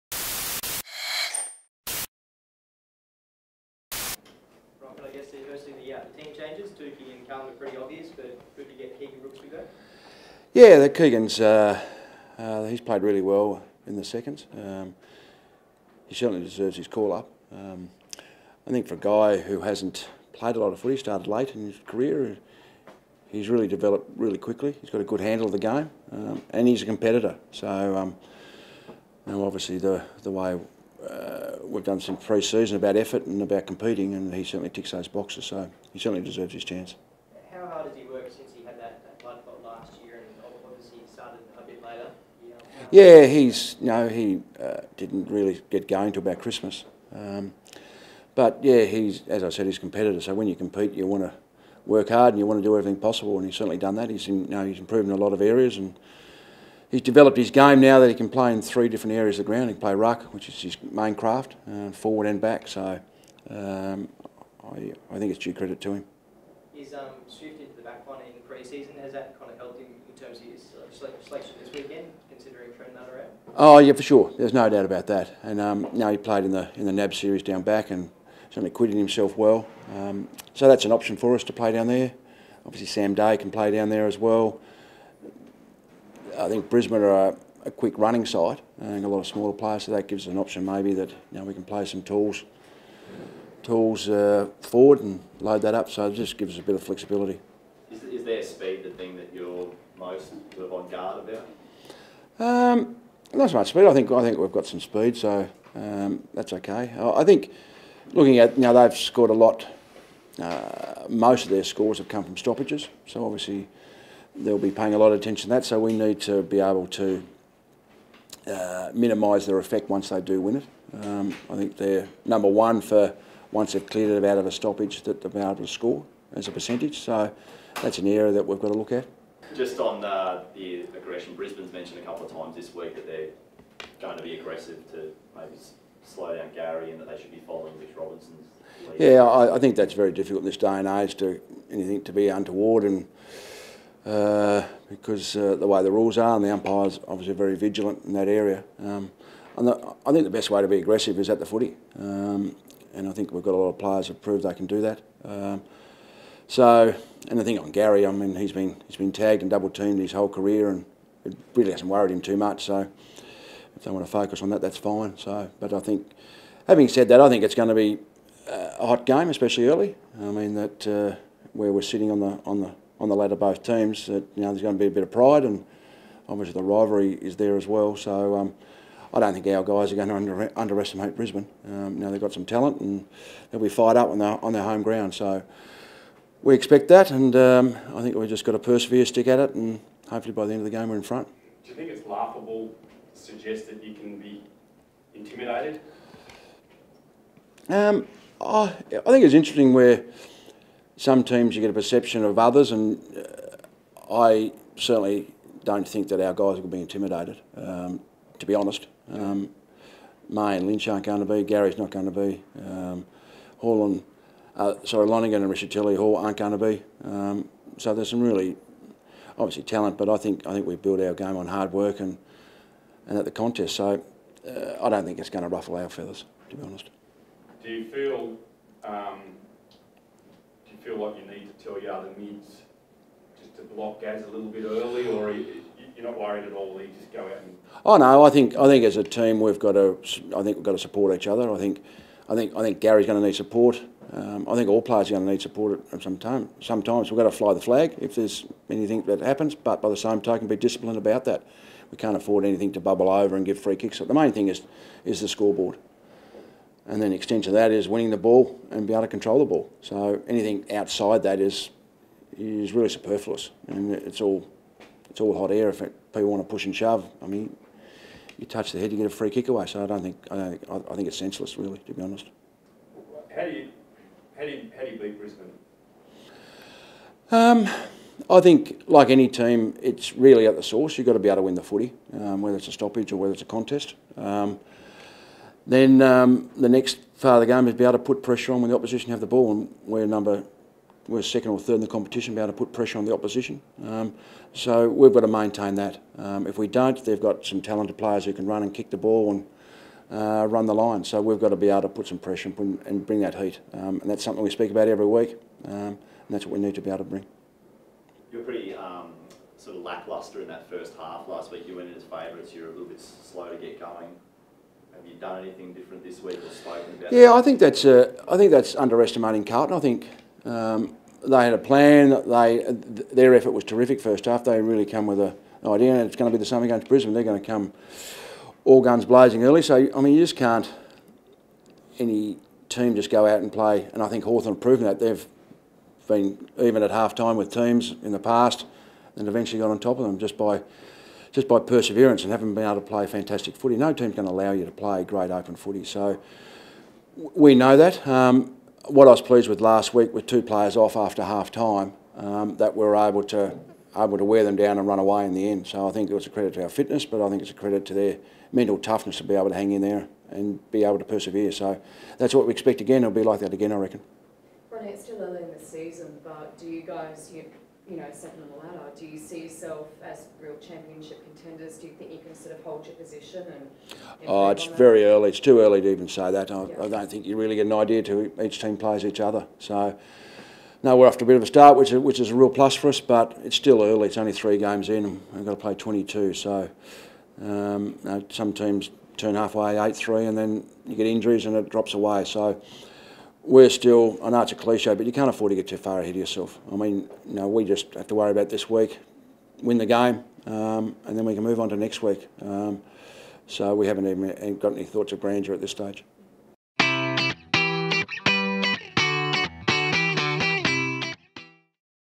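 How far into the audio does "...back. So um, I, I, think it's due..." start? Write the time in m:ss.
1:02.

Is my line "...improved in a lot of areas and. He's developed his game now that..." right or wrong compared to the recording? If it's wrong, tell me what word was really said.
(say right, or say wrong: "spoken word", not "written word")
right.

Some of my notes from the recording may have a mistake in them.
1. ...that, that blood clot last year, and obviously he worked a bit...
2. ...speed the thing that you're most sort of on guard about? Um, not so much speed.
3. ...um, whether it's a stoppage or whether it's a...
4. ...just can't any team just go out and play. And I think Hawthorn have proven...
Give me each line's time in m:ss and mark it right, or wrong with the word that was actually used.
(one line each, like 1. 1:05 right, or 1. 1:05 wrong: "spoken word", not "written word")
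1. 0:38 wrong: "started", not "worked"
2. 1:38 right
3. 4:42 right
4. 5:30 right.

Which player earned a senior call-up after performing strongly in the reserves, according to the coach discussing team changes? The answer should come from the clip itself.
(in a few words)
Keegan Brooksby.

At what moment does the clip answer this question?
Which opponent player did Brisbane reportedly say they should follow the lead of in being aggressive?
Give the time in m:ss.
2:17.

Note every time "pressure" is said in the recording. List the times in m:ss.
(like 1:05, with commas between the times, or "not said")
4:48, 4:52, 5:02.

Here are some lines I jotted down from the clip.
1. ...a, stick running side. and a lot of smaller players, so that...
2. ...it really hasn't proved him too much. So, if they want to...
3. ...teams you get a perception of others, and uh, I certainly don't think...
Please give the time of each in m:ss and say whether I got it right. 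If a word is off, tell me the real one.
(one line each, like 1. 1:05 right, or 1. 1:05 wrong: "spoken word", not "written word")
1. 1:27 wrong: "quick", not "stick"
2. 2:41 wrong: "worried", not "proved"
3. 3:21 right.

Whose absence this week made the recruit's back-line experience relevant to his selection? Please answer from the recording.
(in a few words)
Trent Nutter.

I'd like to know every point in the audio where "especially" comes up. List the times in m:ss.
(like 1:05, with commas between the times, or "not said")
2:49.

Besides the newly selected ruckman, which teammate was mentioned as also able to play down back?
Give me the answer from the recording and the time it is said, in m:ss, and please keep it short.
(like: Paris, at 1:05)
Sam Day, at 1:22.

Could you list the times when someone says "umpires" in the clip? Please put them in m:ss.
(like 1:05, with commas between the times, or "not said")
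2:26.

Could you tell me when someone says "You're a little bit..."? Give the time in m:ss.
5:12.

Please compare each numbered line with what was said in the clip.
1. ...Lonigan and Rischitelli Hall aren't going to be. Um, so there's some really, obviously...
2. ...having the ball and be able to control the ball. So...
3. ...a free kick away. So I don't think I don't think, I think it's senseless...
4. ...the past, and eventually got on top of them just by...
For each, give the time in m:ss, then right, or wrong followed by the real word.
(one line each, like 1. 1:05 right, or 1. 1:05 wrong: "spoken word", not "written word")
1. 3:35 right
2. 4:17 wrong: "winning", not "having"
3. 4:29 right
4. 5:38 right.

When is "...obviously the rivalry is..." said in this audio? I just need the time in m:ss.
2:56.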